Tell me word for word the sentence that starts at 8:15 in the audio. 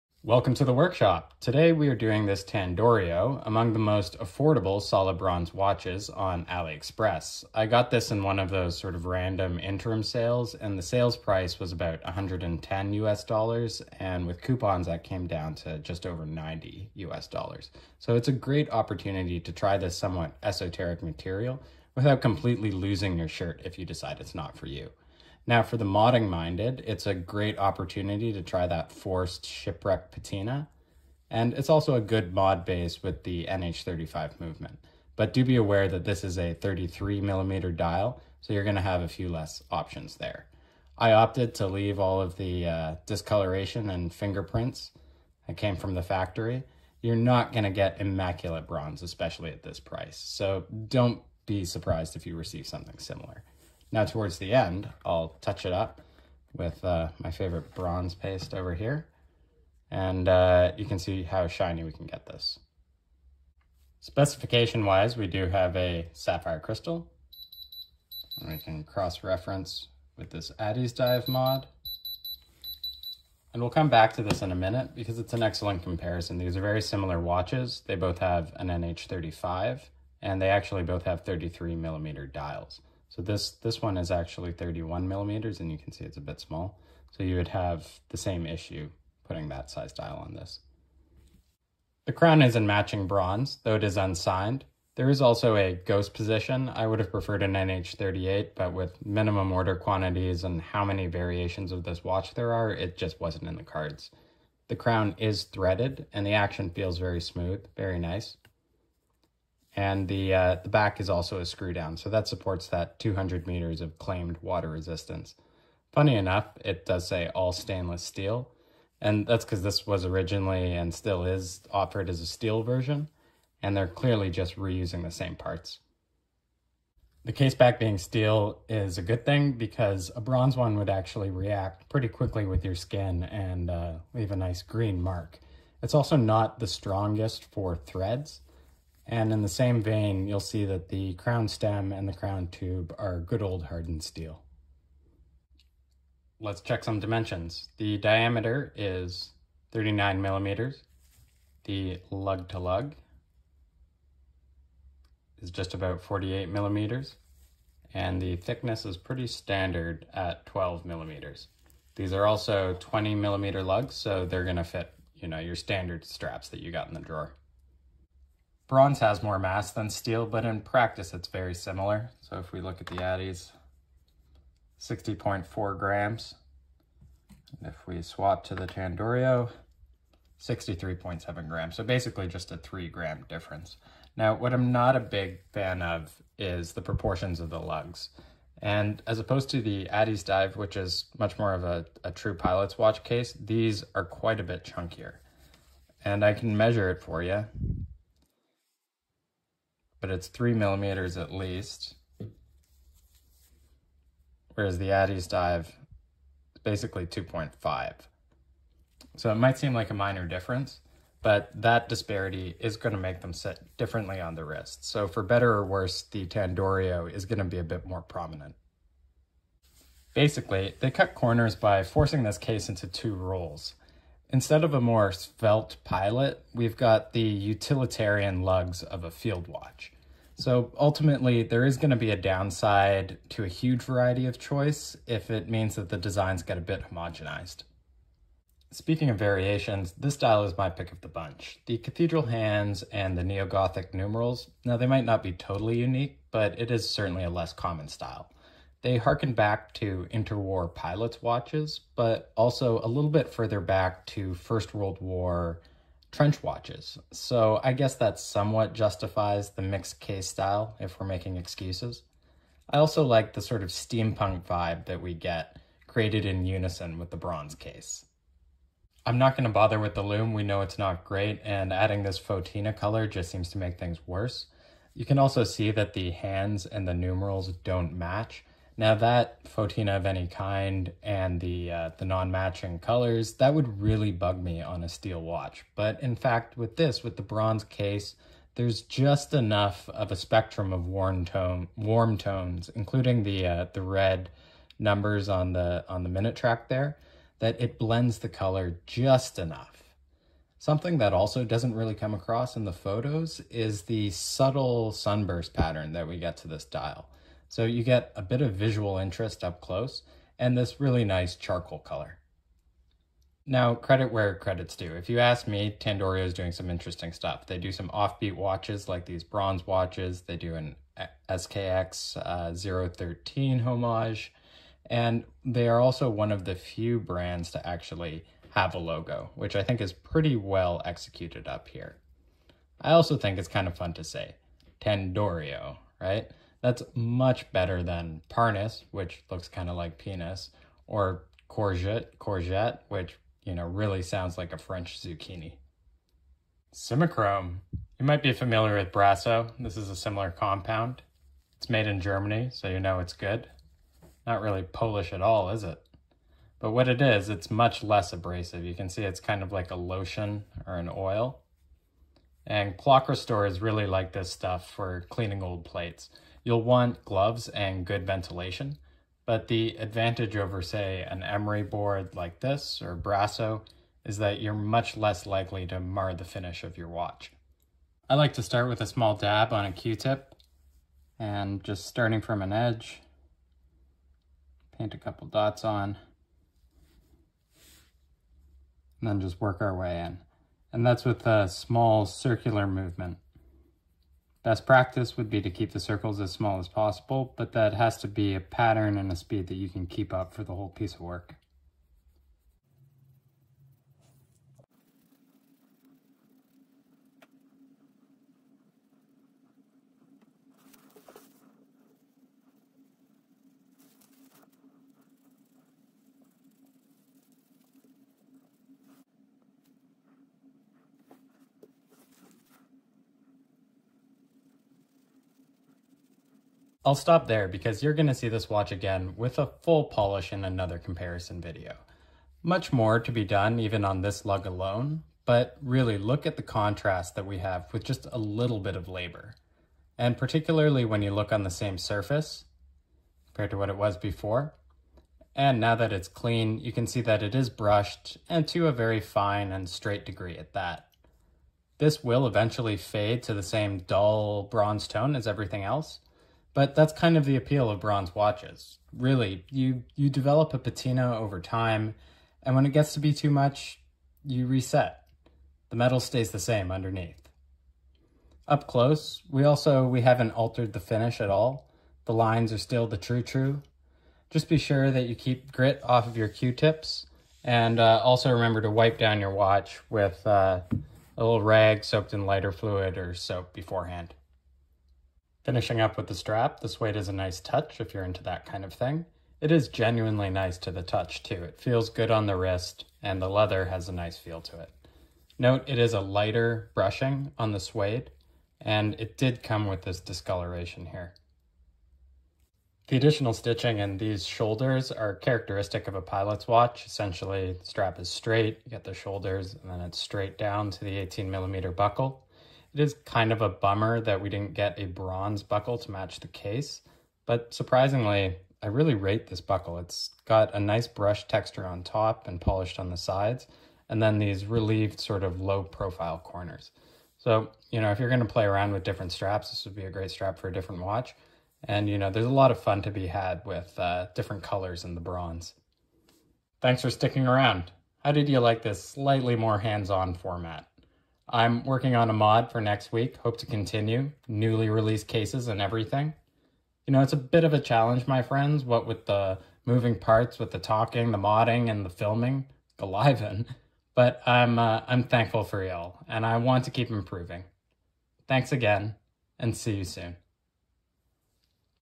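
Note it is a lighter brushing on the suede and it did come with this discoloration here.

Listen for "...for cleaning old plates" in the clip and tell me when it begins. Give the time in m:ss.
6:04.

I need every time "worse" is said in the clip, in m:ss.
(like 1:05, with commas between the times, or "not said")
3:35, 4:34.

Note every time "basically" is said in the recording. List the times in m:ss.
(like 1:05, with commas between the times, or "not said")
3:01, 3:26, 3:40.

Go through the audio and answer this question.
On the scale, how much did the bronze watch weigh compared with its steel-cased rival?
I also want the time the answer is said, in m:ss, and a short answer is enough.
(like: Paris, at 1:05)
63.7 grams, at 3:00.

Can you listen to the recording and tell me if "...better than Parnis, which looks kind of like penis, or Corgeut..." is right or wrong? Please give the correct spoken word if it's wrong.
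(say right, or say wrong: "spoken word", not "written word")
right.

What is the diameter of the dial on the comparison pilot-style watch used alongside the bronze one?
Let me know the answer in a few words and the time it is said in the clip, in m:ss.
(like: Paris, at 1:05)
31 millimeters, at 1:24.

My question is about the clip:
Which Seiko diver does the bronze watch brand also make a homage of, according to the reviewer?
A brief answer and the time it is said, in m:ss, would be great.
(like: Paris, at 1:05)
SKX013, at 5:21.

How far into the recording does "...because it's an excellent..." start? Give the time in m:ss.
1:14.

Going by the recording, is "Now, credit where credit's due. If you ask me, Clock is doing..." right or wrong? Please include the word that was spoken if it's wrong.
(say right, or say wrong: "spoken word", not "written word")
wrong: "Tandorio", not "Clock".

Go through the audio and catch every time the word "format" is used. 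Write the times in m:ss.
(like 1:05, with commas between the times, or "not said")
9:00.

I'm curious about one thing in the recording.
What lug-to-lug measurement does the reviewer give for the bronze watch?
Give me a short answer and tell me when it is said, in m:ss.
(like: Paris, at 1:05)
48 millimeters, at 2:36.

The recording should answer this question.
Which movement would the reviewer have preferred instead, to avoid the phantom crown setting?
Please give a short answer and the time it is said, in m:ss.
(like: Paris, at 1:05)
NH38, at 1:37.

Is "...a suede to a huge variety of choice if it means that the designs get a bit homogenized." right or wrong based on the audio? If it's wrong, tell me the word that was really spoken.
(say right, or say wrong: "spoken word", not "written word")
wrong: "downside", not "suede".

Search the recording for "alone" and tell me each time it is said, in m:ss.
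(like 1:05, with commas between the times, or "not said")
7:14.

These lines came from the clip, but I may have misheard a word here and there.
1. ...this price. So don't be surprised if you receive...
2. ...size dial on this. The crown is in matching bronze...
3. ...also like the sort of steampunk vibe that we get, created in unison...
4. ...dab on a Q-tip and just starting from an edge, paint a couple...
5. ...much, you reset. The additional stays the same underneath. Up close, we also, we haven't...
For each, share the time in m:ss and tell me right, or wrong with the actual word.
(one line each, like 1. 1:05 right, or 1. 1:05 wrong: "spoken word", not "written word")
1. 0:49 right
2. 1:29 right
3. 4:22 right
4. 6:19 right
5. 7:43 wrong: "metal", not "additional".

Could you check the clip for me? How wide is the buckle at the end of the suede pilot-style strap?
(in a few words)
18 millimeters.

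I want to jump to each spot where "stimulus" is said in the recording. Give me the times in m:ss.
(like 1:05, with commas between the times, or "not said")
not said.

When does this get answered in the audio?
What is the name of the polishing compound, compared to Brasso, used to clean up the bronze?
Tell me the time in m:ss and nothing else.
5:46.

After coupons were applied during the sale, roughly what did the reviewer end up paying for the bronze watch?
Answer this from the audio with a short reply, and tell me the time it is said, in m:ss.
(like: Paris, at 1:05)
just over 90 US dollars, at 0:15.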